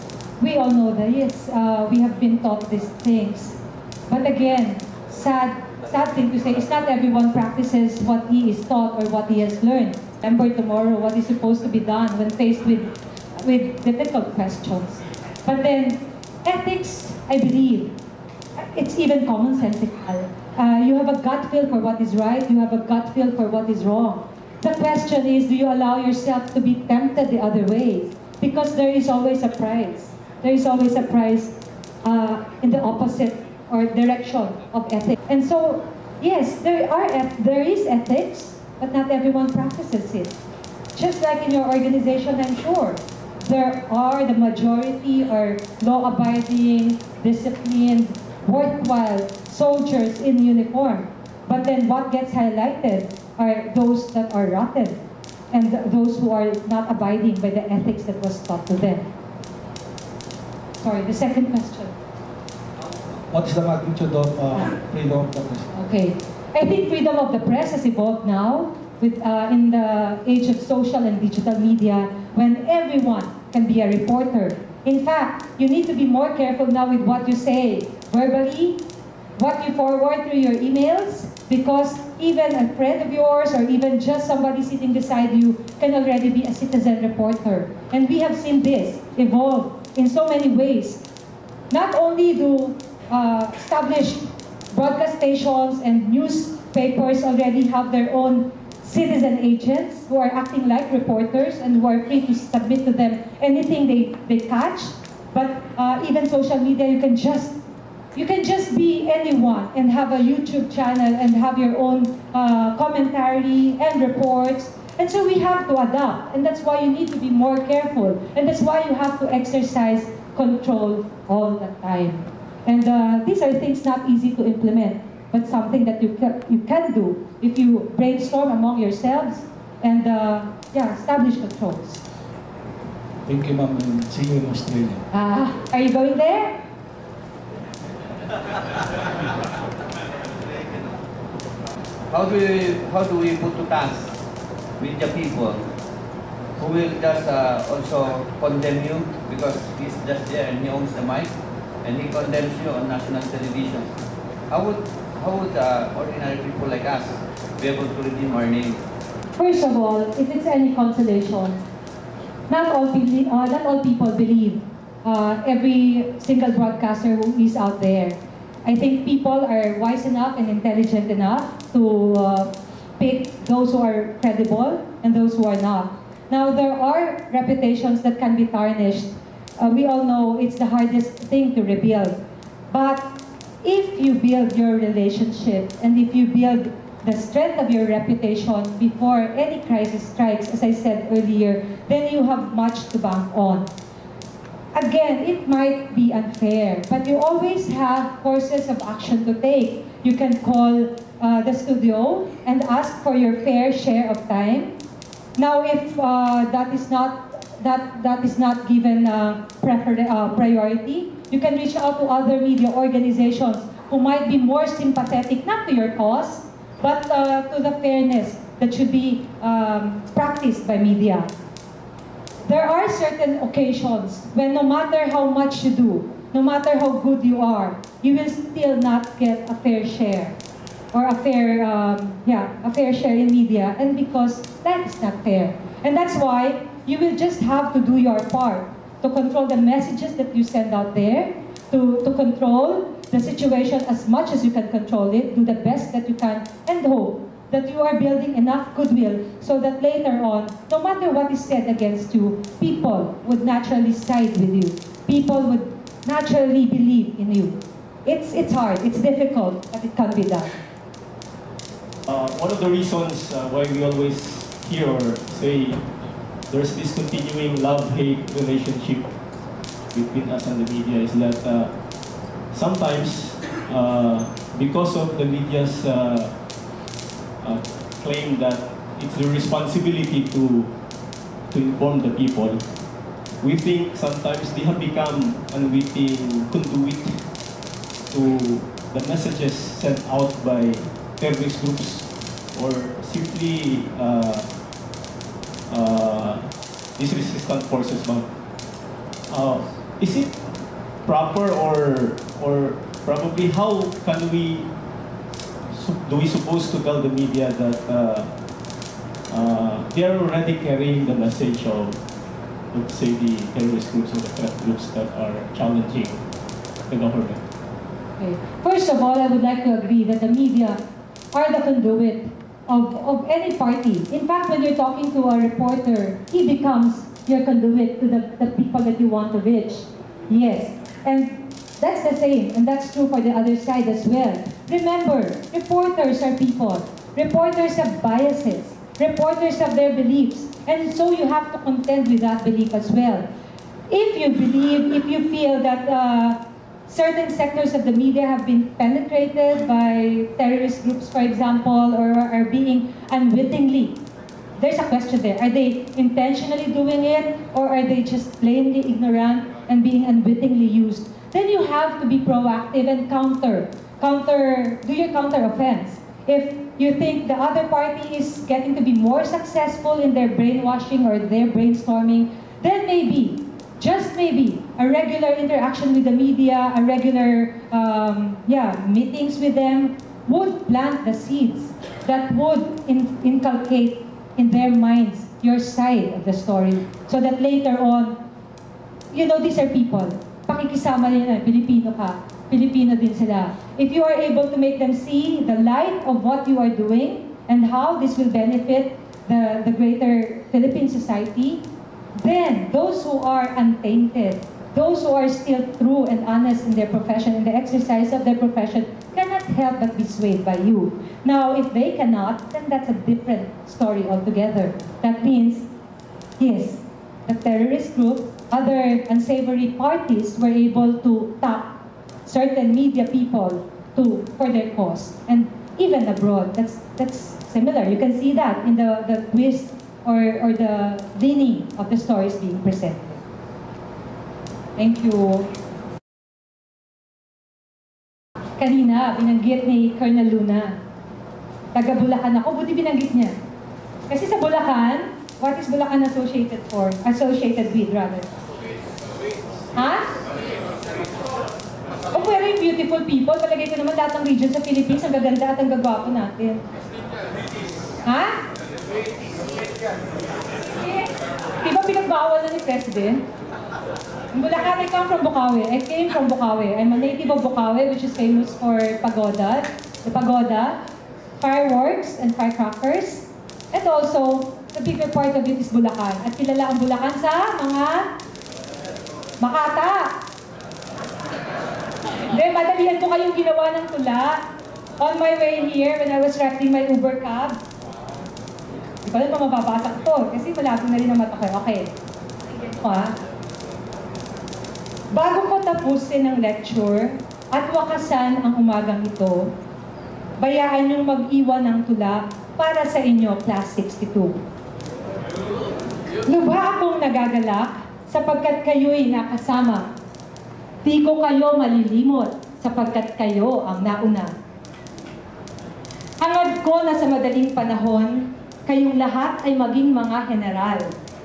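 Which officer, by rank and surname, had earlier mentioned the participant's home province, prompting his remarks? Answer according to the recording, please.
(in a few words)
Colonel Luna.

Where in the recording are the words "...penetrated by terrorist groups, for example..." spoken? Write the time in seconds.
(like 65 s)
348 s.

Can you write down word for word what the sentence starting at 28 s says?
Because there is always a price.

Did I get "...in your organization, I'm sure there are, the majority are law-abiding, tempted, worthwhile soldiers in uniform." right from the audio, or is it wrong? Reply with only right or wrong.
wrong.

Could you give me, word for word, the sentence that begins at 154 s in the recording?
I would how would uh, ordinary people like us be able to redeem our name?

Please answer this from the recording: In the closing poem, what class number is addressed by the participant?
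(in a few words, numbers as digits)
62.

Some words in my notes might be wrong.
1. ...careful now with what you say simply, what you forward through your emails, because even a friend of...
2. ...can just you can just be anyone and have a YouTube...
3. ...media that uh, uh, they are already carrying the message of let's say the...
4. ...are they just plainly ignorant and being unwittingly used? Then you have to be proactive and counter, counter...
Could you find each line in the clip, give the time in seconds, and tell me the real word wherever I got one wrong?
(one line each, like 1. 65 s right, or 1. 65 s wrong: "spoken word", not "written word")
1. 76 s wrong: "verbally", not "simply"
2. 106 s right
3. 307 s right
4. 357 s right.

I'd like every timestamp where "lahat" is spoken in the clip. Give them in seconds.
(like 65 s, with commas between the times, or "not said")
453 s, 518 s.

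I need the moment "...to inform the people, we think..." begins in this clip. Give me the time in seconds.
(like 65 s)
281 s.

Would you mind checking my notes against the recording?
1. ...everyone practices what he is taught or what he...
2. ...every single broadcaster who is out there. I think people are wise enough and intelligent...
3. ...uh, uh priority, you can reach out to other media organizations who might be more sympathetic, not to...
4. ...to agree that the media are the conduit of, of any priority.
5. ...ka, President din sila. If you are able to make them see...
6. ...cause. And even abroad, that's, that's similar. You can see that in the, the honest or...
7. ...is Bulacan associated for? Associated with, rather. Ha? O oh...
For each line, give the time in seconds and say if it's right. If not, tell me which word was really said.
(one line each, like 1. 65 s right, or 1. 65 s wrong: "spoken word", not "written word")
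1. 6 s right
2. 165 s right
3. 209 s right
4. 319 s wrong: "party", not "priority"
5. 391 s wrong: "Pilipino", not "President"
6. 424 s wrong: "twist", not "honest"
7. 445 s right.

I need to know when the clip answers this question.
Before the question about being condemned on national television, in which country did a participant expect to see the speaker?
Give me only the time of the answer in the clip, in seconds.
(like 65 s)
134 s.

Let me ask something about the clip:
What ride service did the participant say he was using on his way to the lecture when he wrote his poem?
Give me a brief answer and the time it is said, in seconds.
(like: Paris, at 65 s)
Uber, at 486 s.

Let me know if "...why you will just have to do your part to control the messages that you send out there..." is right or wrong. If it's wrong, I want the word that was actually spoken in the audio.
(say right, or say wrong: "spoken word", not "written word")
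right.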